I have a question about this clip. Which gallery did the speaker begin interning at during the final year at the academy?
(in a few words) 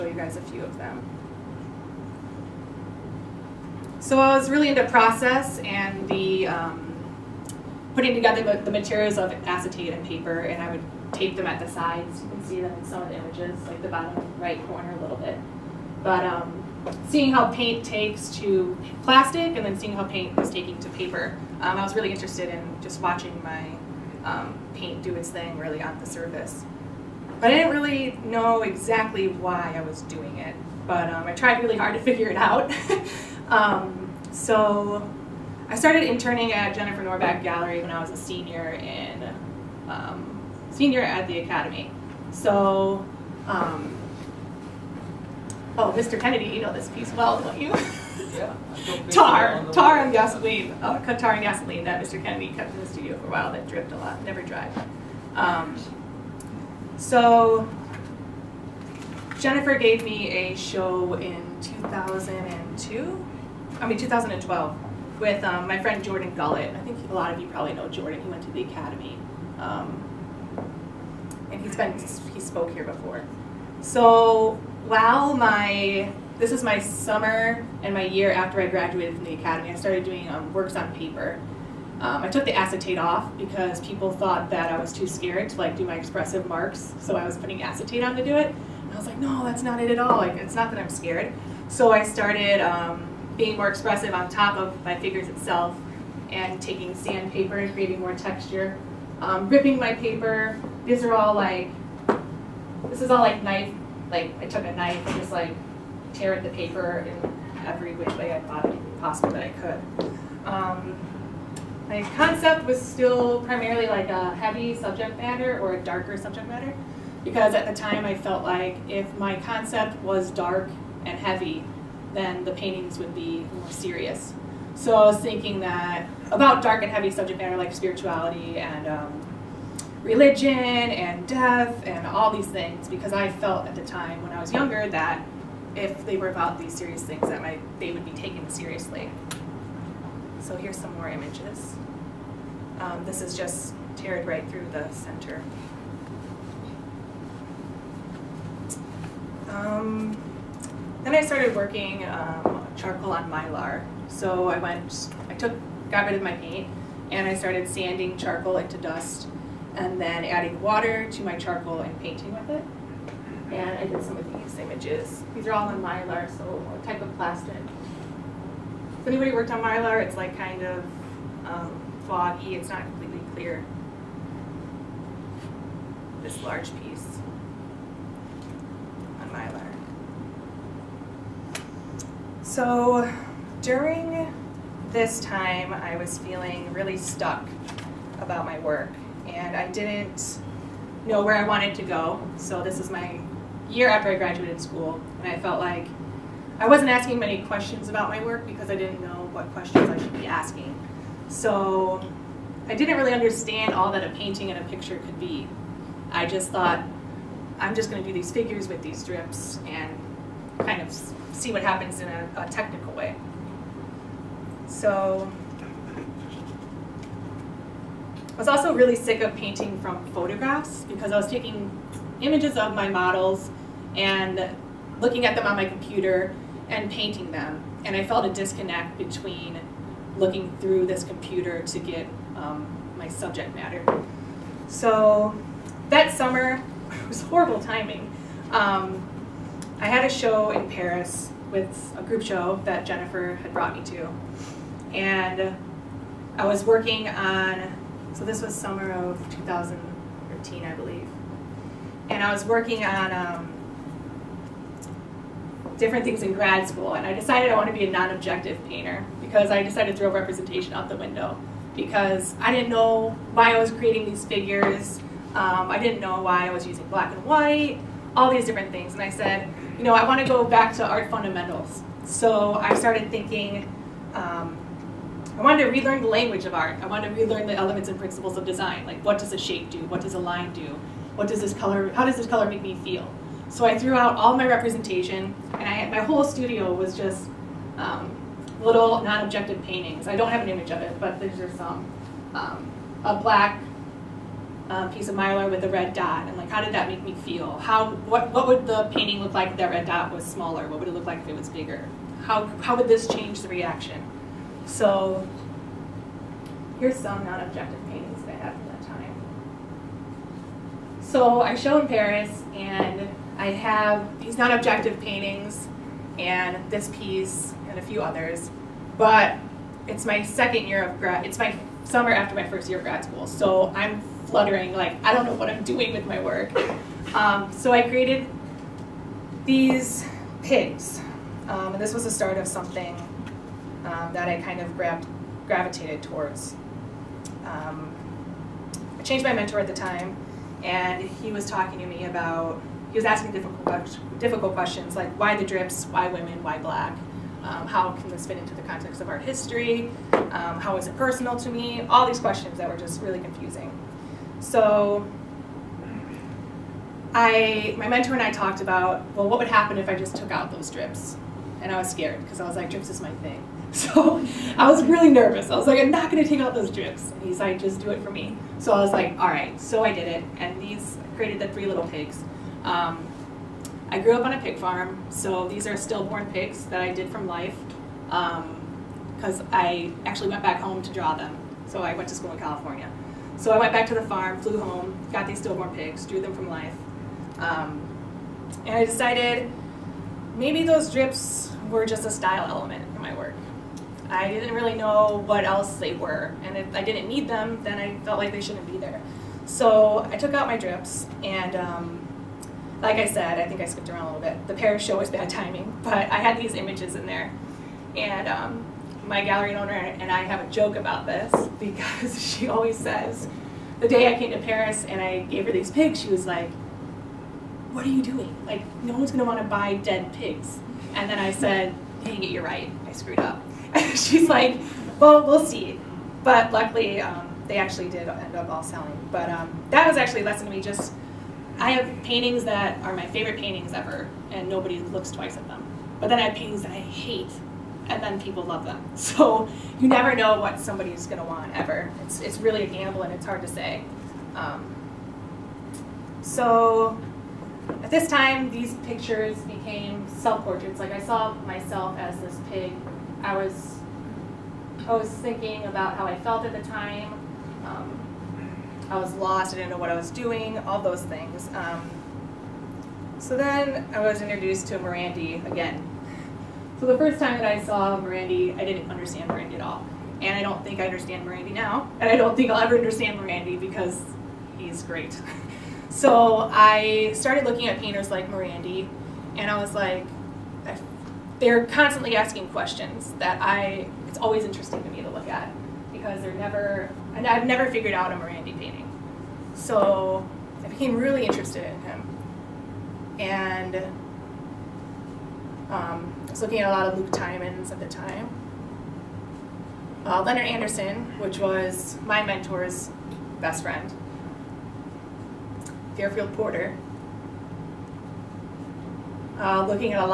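Jennifer Norback Gallery.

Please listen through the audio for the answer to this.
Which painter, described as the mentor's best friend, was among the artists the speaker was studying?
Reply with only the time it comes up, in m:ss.
8:20.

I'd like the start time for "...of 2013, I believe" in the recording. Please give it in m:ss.
4:08.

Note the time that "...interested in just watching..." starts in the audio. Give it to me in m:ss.
0:22.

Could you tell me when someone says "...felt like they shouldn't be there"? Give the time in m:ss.
6:38.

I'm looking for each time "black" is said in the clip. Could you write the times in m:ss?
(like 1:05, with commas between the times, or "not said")
4:26, 4:53, 5:46.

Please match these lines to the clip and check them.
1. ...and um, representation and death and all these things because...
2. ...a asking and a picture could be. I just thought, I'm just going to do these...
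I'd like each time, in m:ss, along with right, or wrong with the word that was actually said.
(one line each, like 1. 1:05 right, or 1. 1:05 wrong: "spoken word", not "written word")
1. 2:08 wrong: "religion", not "representation"
2. 3:24 wrong: "painting", not "asking".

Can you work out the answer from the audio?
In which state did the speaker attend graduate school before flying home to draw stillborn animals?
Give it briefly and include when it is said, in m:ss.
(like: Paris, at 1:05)
California, at 6:22.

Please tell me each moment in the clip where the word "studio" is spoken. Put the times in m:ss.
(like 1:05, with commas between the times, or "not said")
0:52, 4:46.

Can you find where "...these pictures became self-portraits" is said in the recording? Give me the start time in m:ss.
7:28.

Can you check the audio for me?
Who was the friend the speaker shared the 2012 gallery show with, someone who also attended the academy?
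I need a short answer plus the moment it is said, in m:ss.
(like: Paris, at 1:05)
Jordan Gullett, at 1:06.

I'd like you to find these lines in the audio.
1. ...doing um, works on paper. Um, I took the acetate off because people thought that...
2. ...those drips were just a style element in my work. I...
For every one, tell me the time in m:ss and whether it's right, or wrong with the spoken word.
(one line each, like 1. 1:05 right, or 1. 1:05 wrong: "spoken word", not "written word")
1. 1:20 right
2. 6:30 right.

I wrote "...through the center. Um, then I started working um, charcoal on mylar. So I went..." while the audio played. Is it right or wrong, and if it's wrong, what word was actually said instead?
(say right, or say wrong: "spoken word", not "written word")
right.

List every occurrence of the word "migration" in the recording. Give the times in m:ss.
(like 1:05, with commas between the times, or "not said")
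not said.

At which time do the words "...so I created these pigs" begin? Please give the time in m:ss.
5:27.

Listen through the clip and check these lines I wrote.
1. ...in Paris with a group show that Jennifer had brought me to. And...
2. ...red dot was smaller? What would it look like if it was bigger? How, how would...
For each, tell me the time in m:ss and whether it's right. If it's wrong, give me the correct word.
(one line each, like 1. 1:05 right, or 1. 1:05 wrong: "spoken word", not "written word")
1. 4:00 right
2. 4:59 right.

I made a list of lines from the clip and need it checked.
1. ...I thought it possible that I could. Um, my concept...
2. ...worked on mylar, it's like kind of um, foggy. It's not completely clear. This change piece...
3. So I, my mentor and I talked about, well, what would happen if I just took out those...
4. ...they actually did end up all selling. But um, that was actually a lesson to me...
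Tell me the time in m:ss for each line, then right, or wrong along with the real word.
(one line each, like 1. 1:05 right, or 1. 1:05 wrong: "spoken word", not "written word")
1. 1:48 right
2. 2:49 wrong: "large", not "change"
3. 5:54 right
4. 7:07 right.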